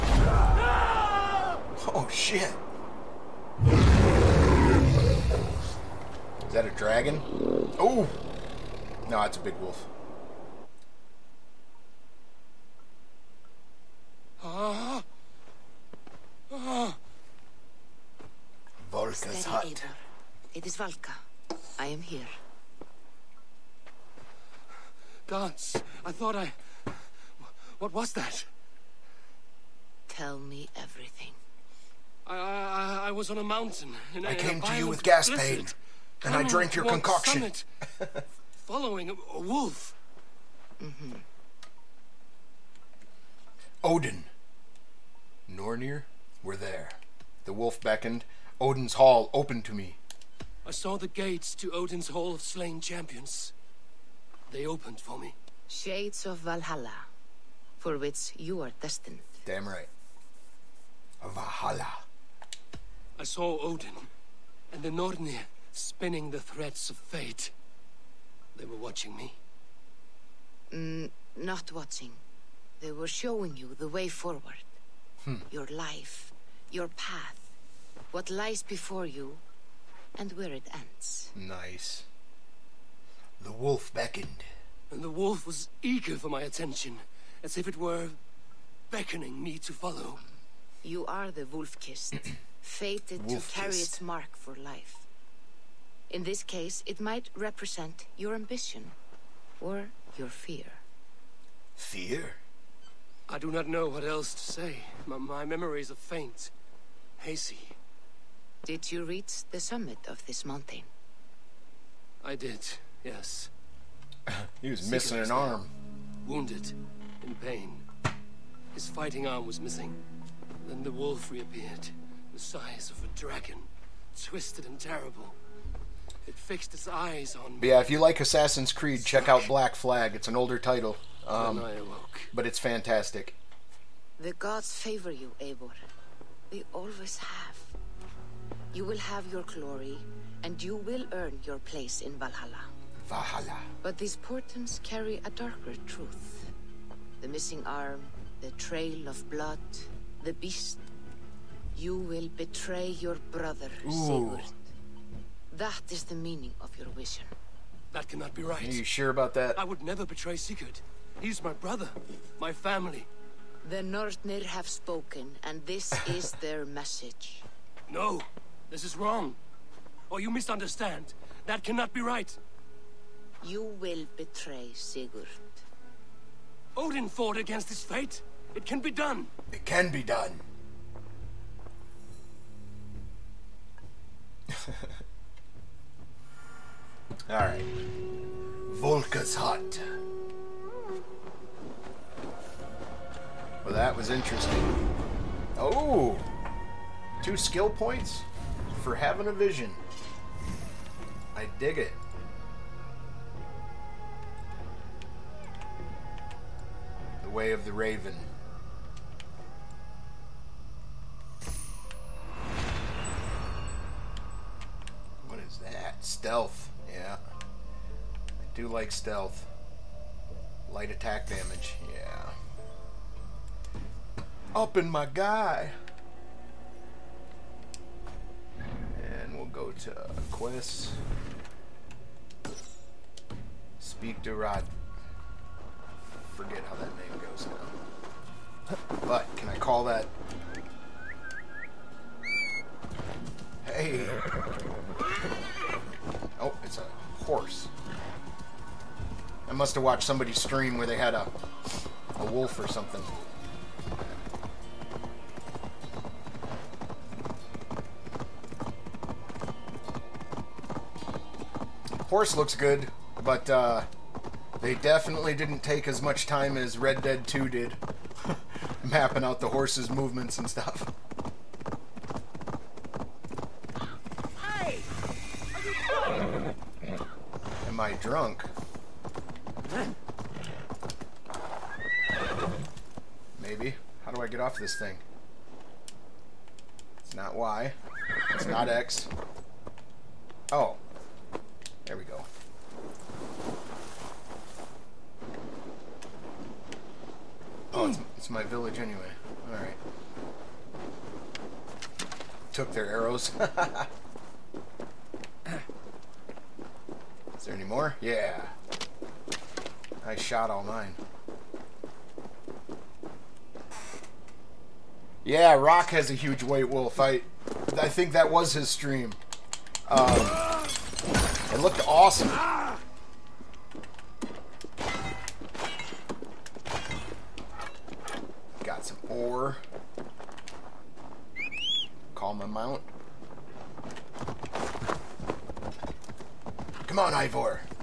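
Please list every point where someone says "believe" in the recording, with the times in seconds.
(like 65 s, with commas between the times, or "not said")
not said.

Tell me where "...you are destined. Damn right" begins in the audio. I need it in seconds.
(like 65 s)
58 s.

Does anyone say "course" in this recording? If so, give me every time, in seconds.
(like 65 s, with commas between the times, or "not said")
not said.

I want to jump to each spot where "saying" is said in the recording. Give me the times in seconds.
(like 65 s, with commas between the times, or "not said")
not said.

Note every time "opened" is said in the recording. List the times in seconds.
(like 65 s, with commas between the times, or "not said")
49 s, 54 s.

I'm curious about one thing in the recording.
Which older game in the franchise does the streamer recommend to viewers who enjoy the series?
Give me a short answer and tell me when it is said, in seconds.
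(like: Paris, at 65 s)
Black Flag, at 129 s.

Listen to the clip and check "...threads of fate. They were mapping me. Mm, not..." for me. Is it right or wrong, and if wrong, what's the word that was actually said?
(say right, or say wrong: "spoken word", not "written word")
wrong: "watching", not "mapping".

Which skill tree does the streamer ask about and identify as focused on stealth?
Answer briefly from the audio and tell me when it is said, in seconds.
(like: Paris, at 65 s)
The Way of the Raven, at 207 s.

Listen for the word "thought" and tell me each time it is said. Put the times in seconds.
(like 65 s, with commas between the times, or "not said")
26 s.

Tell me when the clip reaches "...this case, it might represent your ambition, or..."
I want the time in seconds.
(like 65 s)
96 s.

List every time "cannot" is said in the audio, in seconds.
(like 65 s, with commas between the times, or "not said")
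158 s, 171 s.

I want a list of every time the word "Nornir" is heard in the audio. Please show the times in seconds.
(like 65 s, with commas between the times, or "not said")
45 s, 64 s, 163 s.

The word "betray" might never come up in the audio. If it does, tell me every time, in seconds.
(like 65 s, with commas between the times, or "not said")
152 s, 160 s, 174 s.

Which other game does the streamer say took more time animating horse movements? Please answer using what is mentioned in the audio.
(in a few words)
Red Dead 2.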